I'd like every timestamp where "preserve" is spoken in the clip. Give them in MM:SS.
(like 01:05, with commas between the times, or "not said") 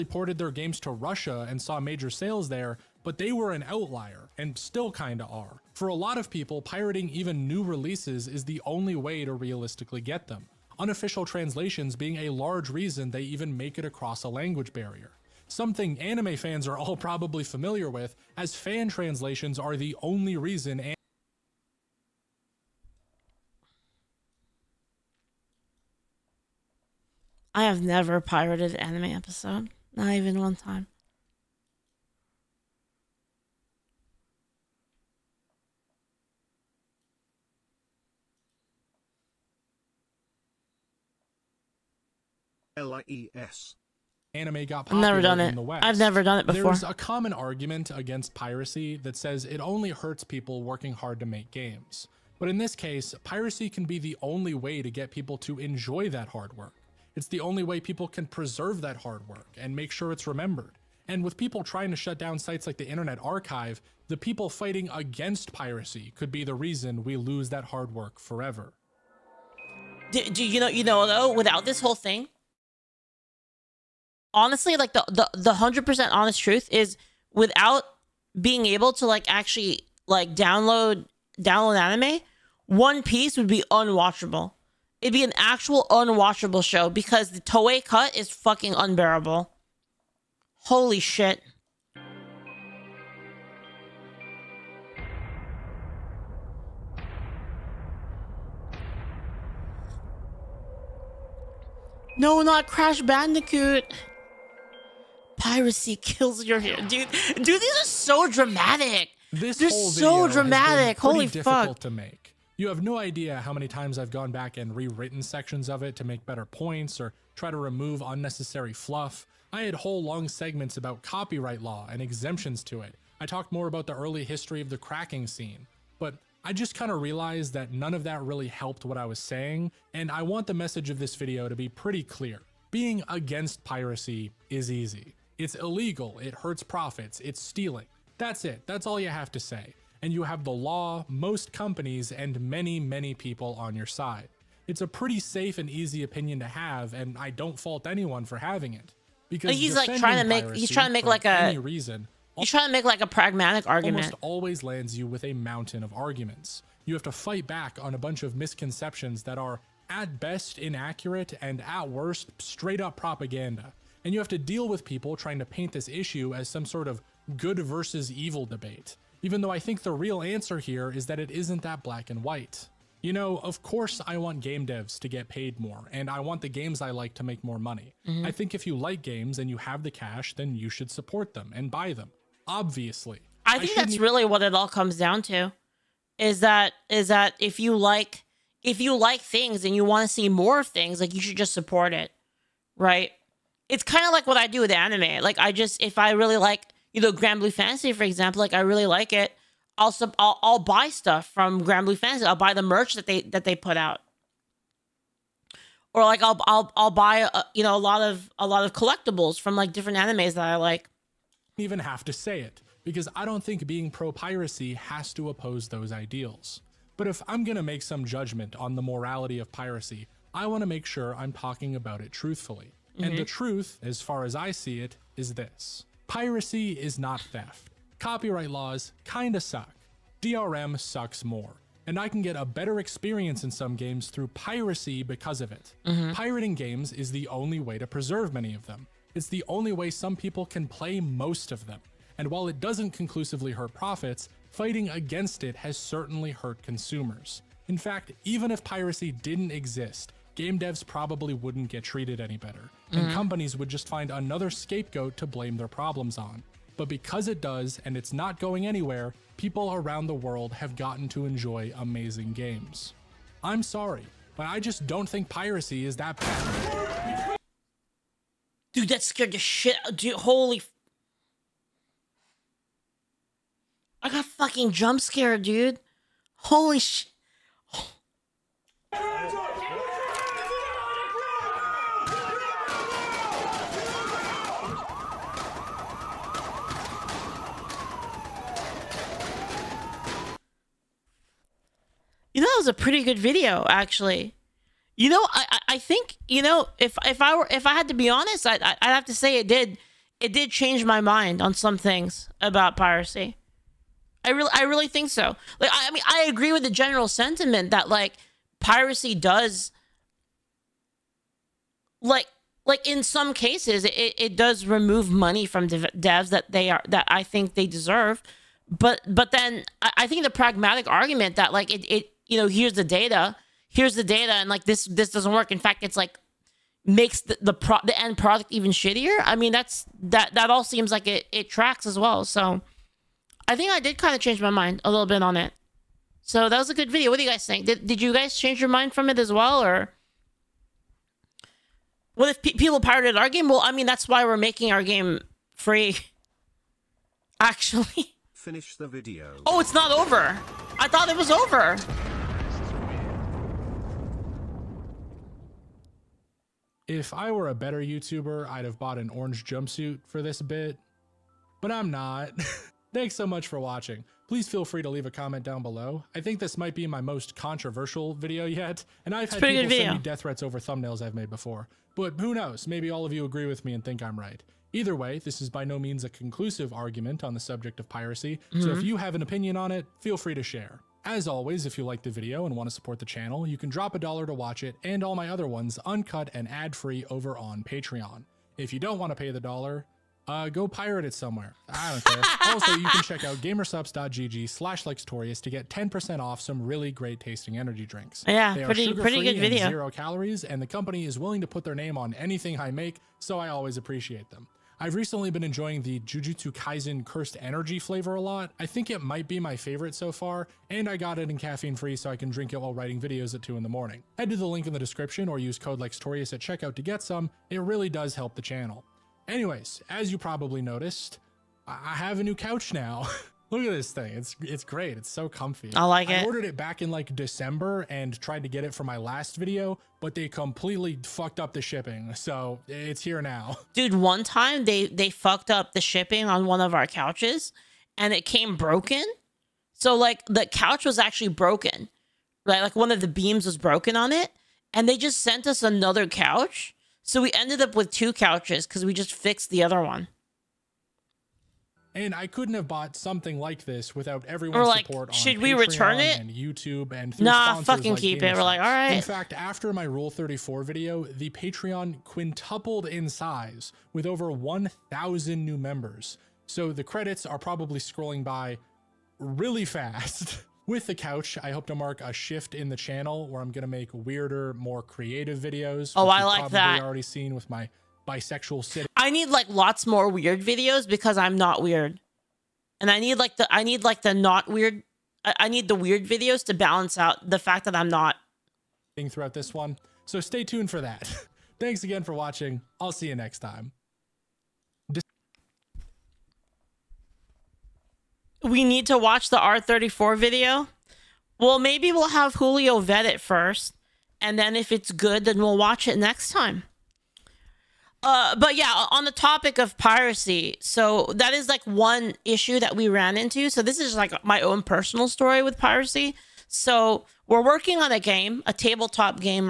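00:58, 03:57.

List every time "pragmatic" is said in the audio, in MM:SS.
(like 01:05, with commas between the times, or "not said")
02:33, 05:20.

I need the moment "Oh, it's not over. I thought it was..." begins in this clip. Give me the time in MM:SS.
05:49.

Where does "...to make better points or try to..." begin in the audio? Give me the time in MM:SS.
01:55.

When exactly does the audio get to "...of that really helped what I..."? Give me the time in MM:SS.
02:07.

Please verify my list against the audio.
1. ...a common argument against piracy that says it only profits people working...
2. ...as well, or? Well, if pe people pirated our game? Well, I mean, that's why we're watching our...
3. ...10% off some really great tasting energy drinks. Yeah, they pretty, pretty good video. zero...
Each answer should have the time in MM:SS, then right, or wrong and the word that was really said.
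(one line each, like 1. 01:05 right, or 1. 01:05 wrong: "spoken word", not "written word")
1. 00:46 wrong: "hurts", not "profits"
2. 05:39 wrong: "making", not "watching"
3. 06:35 right.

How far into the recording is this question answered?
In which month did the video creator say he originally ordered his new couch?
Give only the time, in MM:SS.
07:07.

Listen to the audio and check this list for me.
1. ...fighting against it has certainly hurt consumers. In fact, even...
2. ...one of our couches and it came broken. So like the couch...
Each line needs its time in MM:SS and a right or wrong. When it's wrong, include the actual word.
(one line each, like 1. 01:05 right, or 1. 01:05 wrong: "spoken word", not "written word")
1. 04:04 right
2. 07:16 right.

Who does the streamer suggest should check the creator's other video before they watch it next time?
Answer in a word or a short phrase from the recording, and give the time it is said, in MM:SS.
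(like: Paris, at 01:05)
Julio, at 08:22.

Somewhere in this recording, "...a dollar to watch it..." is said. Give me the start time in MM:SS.
06:23.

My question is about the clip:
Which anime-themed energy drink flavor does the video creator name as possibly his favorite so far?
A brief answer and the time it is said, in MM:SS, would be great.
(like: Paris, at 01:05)
Jujutsu Kaisen Cursed Energy, at 06:45.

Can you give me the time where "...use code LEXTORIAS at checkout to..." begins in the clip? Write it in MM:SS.
06:55.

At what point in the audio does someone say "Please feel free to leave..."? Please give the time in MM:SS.
06:04.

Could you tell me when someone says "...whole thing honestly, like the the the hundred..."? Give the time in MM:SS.
01:11.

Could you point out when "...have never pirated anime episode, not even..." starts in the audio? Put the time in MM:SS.
00:27.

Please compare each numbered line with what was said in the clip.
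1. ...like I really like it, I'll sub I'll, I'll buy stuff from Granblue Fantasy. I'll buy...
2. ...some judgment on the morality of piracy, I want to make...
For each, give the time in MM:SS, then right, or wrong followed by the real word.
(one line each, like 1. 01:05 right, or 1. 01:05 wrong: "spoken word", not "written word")
1. 03:18 right
2. 03:37 right.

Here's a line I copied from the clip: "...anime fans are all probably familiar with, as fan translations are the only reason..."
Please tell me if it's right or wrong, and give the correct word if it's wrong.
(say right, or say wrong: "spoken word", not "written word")
right.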